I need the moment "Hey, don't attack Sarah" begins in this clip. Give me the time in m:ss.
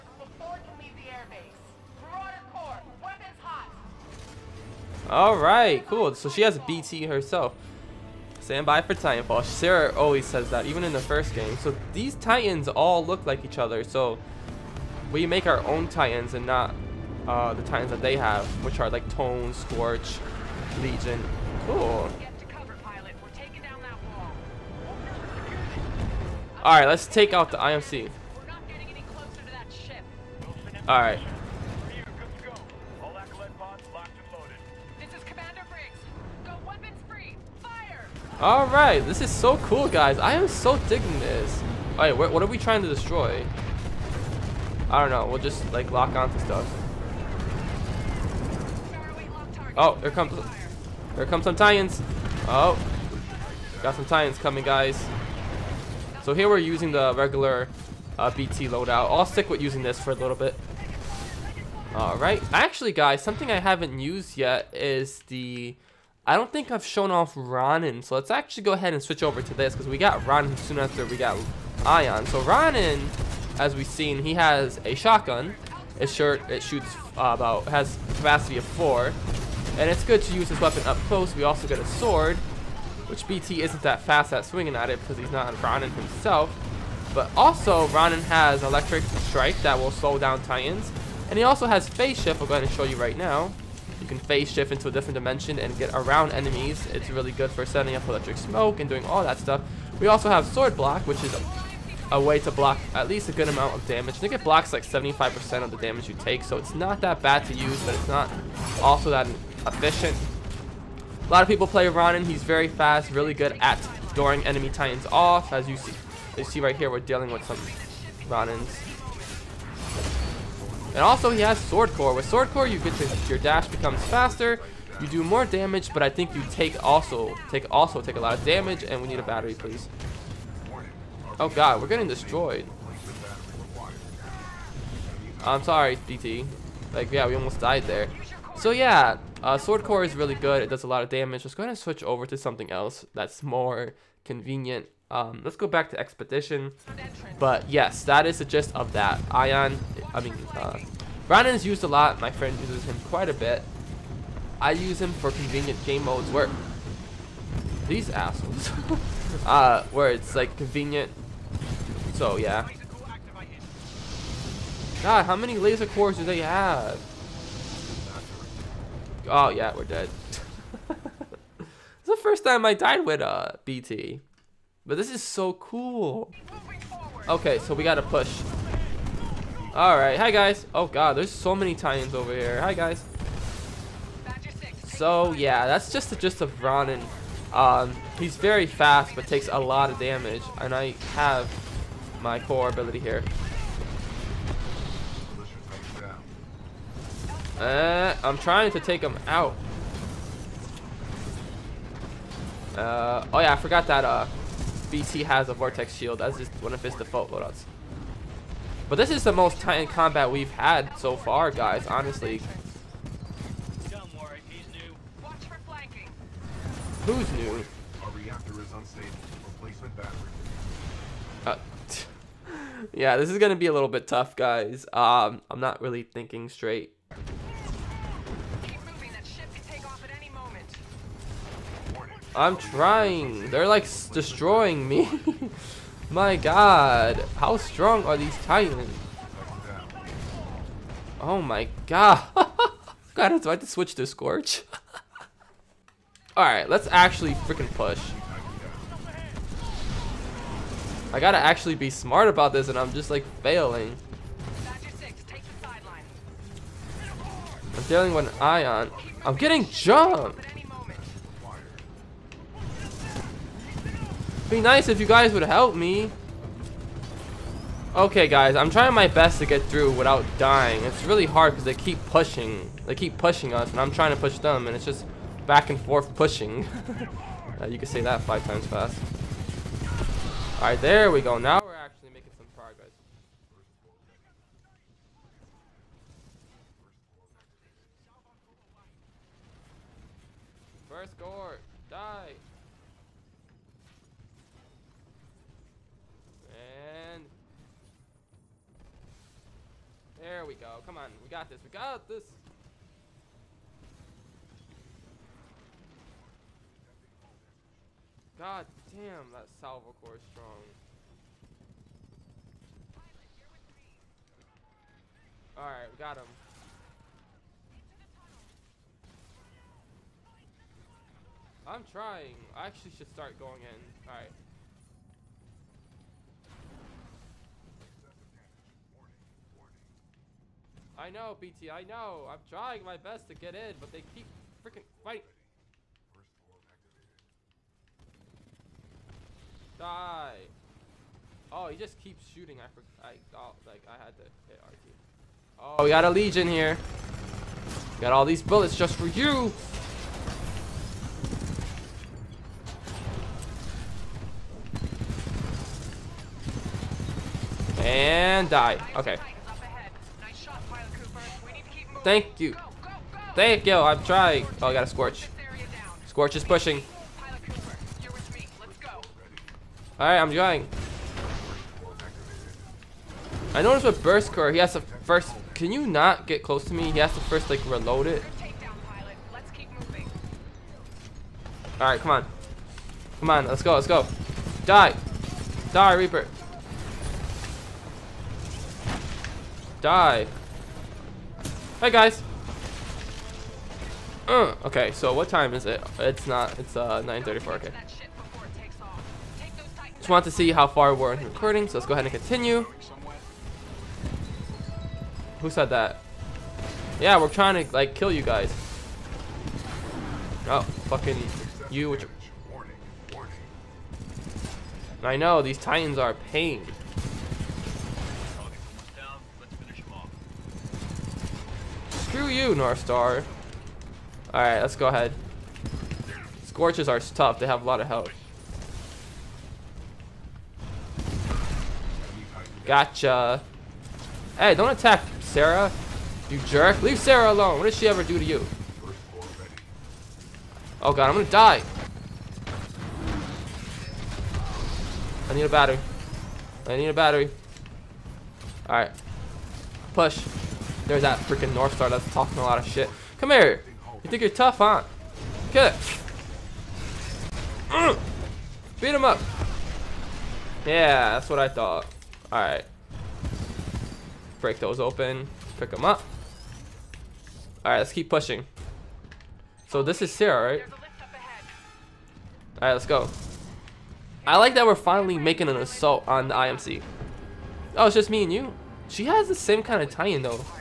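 7:14.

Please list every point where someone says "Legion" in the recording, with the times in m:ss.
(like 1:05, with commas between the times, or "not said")
0:20, 5:46.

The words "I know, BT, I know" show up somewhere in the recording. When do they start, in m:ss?
5:30.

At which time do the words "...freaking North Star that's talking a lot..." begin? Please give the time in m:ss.
7:31.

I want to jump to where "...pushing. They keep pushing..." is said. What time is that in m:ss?
4:32.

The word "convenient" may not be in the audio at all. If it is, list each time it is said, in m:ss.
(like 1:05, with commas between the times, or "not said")
2:24, 2:35, 2:40.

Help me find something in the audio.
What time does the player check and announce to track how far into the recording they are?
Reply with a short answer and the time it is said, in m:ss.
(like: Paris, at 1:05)
9:34, at 6:37.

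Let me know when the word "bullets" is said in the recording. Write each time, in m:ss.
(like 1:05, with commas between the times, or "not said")
5:48.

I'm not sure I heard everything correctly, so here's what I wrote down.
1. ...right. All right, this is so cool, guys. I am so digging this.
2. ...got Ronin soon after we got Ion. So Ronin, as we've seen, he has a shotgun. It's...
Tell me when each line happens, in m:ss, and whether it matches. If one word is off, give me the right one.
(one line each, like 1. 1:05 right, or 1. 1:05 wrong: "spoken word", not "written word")
1. 0:30 right
2. 1:09 right.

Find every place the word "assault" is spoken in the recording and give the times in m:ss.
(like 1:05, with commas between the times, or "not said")
7:55.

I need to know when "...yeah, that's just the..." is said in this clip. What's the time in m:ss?
3:05.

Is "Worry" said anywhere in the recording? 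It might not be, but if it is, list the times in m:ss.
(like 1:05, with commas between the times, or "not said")
3:34.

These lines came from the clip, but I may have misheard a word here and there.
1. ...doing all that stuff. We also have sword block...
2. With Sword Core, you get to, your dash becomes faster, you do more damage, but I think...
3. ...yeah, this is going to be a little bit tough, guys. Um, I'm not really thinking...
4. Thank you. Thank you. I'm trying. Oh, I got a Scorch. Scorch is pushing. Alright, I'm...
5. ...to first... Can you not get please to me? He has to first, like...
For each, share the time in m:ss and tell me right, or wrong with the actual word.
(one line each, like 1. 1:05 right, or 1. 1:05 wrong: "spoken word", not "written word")
1. 1:38 right
2. 2:02 right
3. 3:42 right
4. 6:02 right
5. 6:14 wrong: "close", not "please".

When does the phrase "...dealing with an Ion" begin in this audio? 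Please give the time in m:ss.
4:17.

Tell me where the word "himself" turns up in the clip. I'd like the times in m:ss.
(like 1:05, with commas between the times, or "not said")
1:25.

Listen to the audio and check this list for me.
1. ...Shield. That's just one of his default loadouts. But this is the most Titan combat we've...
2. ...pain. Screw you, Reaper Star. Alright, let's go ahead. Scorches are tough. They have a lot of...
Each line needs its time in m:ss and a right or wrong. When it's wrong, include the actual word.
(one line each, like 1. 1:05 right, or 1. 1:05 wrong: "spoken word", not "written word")
1. 3:25 right
2. 6:56 wrong: "North", not "Reaper".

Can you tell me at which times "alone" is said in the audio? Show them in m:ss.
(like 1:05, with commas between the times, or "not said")
7:17.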